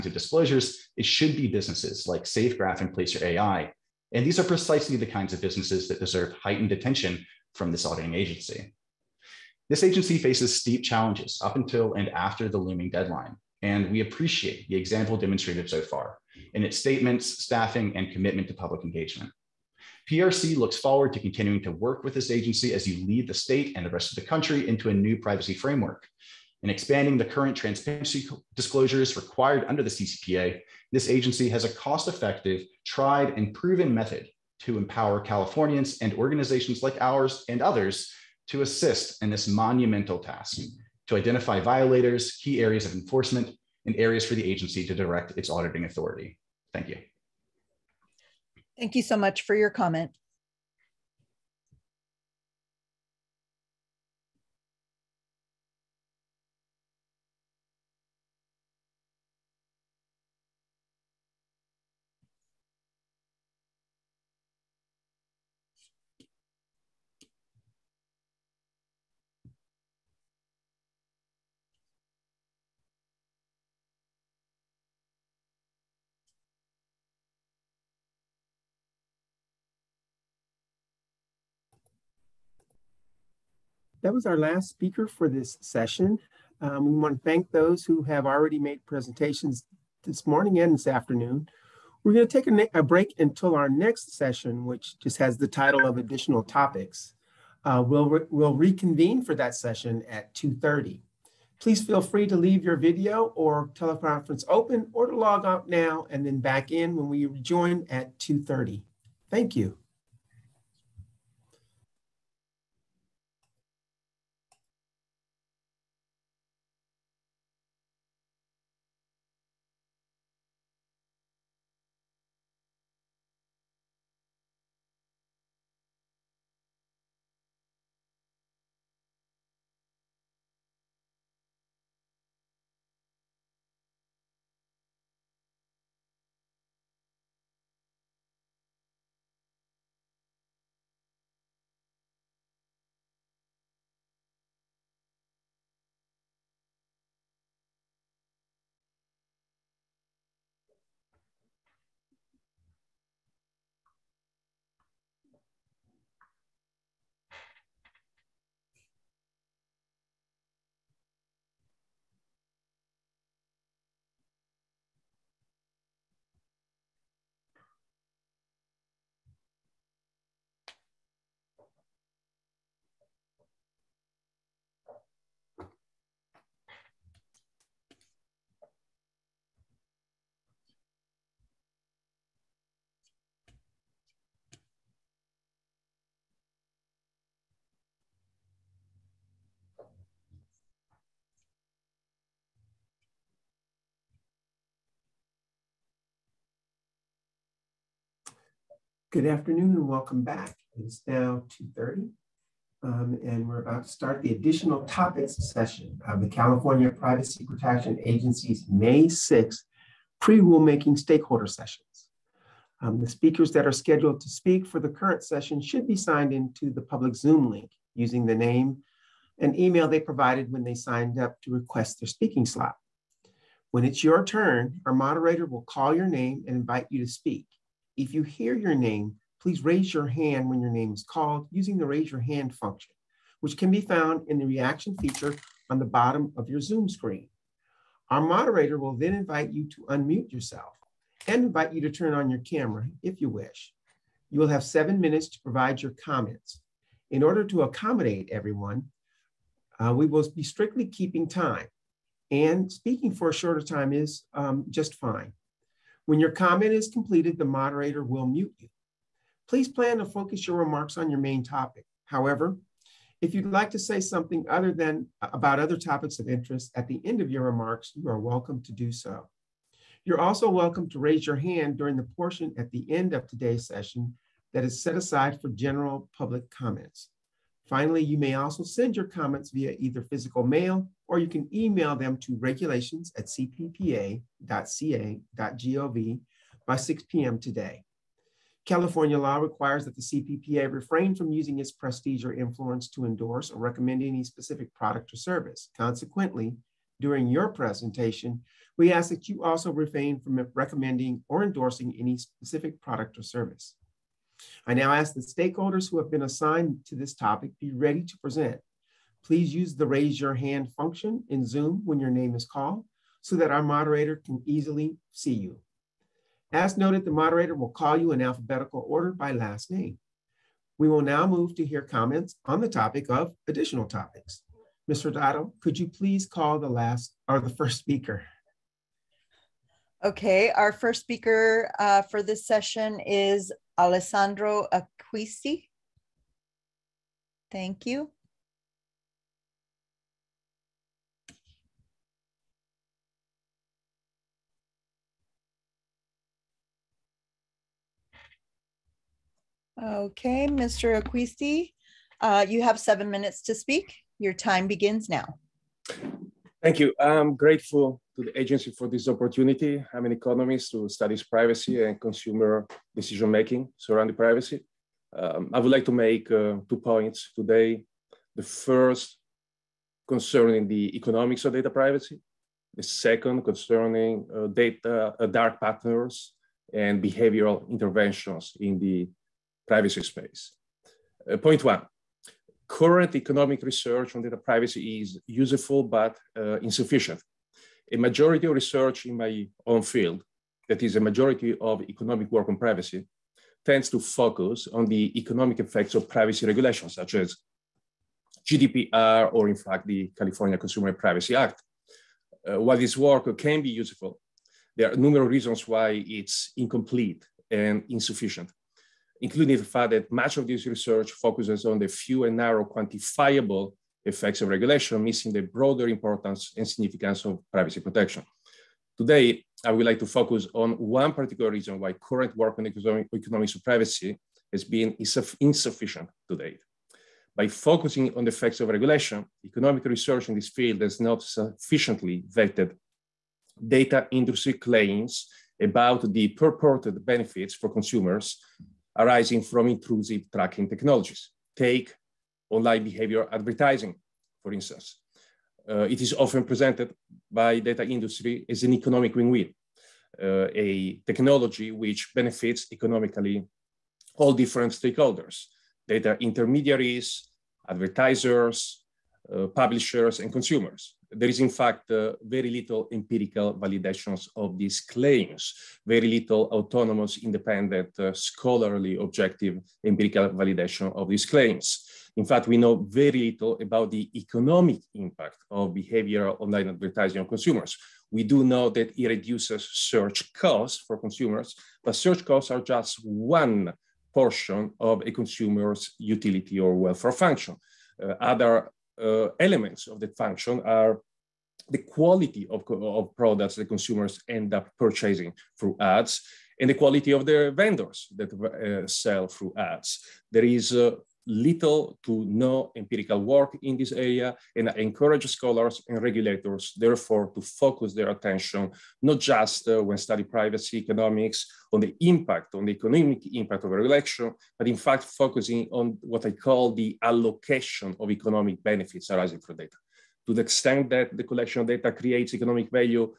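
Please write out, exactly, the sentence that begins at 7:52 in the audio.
In fact, we know very little about the economic impact of behavioral online advertising on consumers.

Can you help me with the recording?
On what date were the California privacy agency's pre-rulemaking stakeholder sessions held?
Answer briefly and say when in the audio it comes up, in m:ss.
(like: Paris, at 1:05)
May 6th, at 3:28.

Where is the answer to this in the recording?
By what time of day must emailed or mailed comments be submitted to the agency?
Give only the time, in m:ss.
4:46.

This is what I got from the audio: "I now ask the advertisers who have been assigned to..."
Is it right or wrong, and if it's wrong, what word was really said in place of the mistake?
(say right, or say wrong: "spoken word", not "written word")
wrong: "stakeholders", not "advertisers".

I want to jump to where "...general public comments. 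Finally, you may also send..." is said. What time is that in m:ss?
4:35.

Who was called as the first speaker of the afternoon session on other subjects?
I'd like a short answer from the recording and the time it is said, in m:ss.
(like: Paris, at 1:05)
Alessandro Acquisti, at 5:33.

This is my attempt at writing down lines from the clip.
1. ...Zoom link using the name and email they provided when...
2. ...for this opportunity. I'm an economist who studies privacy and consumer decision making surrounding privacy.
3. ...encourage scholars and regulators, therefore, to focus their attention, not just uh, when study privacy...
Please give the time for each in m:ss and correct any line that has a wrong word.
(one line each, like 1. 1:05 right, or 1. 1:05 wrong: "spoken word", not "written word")
1. 3:37 right
2. 5:58 right
3. 8:24 right.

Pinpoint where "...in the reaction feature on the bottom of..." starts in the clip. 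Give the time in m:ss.
3:54.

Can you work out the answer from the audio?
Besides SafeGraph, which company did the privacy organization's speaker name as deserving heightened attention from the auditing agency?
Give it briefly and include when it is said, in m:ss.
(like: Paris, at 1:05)
Placer AI, at 0:02.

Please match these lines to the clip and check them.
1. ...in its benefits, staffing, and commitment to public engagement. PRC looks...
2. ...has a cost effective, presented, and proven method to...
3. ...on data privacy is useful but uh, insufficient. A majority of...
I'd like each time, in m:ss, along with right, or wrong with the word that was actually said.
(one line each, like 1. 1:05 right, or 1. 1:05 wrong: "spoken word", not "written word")
1. 0:16 wrong: "statements", not "benefits"
2. 0:31 wrong: "tried", not "presented"
3. 6:24 right.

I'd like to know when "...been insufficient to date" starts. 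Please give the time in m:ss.
7:04.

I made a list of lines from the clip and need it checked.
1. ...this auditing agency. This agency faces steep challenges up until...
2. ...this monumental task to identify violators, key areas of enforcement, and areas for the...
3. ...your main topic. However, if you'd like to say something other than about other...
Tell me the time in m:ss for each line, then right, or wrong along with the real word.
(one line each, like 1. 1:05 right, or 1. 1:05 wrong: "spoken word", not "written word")
1. 0:07 right
2. 0:39 right
3. 4:21 right.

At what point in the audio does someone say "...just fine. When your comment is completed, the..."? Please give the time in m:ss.
4:14.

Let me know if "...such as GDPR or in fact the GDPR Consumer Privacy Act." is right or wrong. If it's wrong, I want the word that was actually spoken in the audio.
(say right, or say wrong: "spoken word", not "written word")
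wrong: "California", not "GDPR".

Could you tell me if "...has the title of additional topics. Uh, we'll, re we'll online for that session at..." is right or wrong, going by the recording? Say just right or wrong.
wrong.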